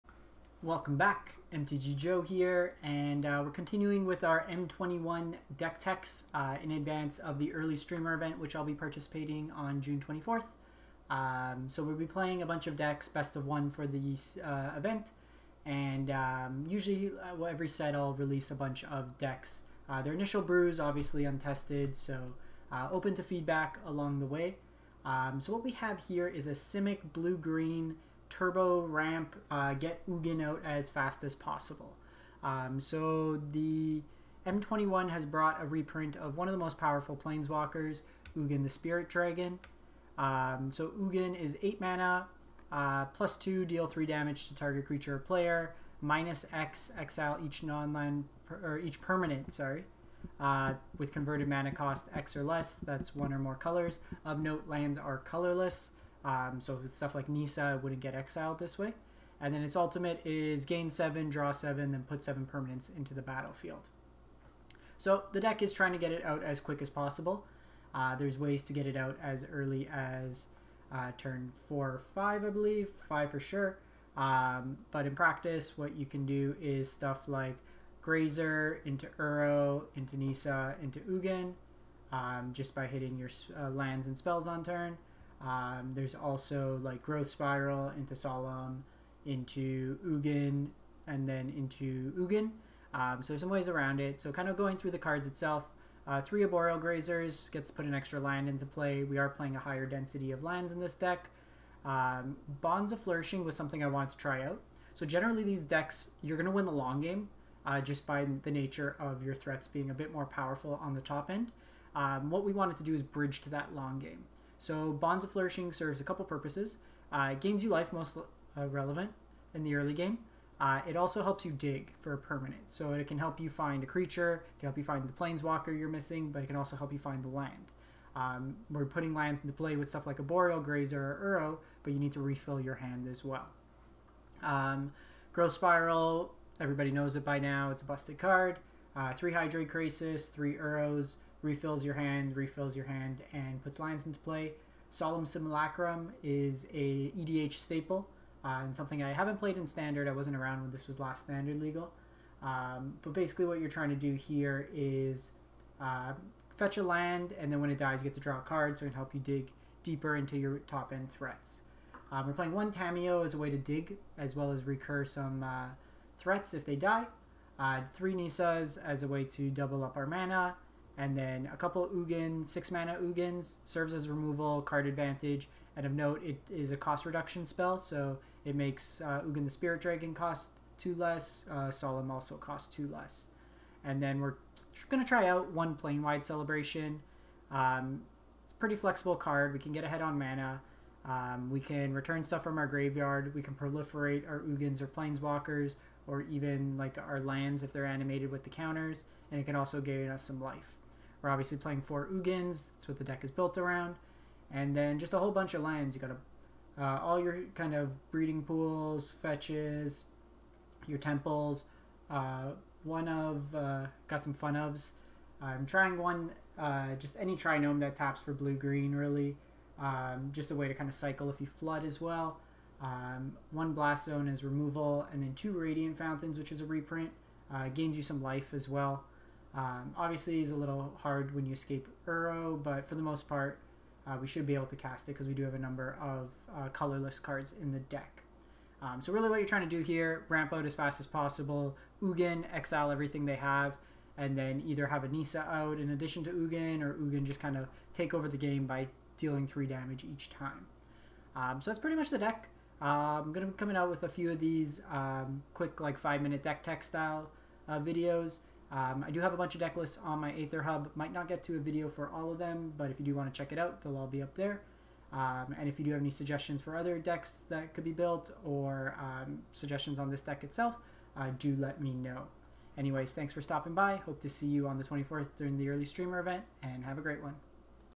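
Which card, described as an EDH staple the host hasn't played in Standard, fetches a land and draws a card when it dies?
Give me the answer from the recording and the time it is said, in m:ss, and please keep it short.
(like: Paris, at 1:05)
Solemn Simulacrum, at 2:24.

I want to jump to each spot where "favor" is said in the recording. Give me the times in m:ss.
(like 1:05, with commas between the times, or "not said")
not said.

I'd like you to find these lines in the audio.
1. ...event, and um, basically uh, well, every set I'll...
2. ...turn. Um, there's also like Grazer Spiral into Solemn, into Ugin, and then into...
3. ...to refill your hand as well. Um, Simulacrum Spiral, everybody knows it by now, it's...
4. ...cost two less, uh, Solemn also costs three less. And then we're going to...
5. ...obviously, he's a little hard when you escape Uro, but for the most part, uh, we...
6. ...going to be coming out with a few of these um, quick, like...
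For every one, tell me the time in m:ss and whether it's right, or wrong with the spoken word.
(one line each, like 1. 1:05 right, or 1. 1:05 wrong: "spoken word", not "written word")
1. 0:14 wrong: "usually", not "basically"
2. 1:24 wrong: "Growth", not "Grazer"
3. 2:12 wrong: "Growth", not "Simulacrum"
4. 3:00 wrong: "two", not "three"
5. 3:49 right
6. 4:13 right.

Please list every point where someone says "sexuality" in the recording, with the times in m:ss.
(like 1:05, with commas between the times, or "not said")
not said.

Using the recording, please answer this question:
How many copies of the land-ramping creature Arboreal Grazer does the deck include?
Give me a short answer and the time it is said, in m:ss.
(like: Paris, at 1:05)
3, at 1:36.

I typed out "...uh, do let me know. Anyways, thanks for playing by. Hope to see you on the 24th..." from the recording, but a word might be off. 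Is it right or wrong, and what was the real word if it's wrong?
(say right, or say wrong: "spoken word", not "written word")
wrong: "stopping", not "playing".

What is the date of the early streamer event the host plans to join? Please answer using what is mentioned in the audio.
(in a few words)
June 24th.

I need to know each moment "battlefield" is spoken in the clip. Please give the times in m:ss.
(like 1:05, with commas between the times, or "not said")
1:03.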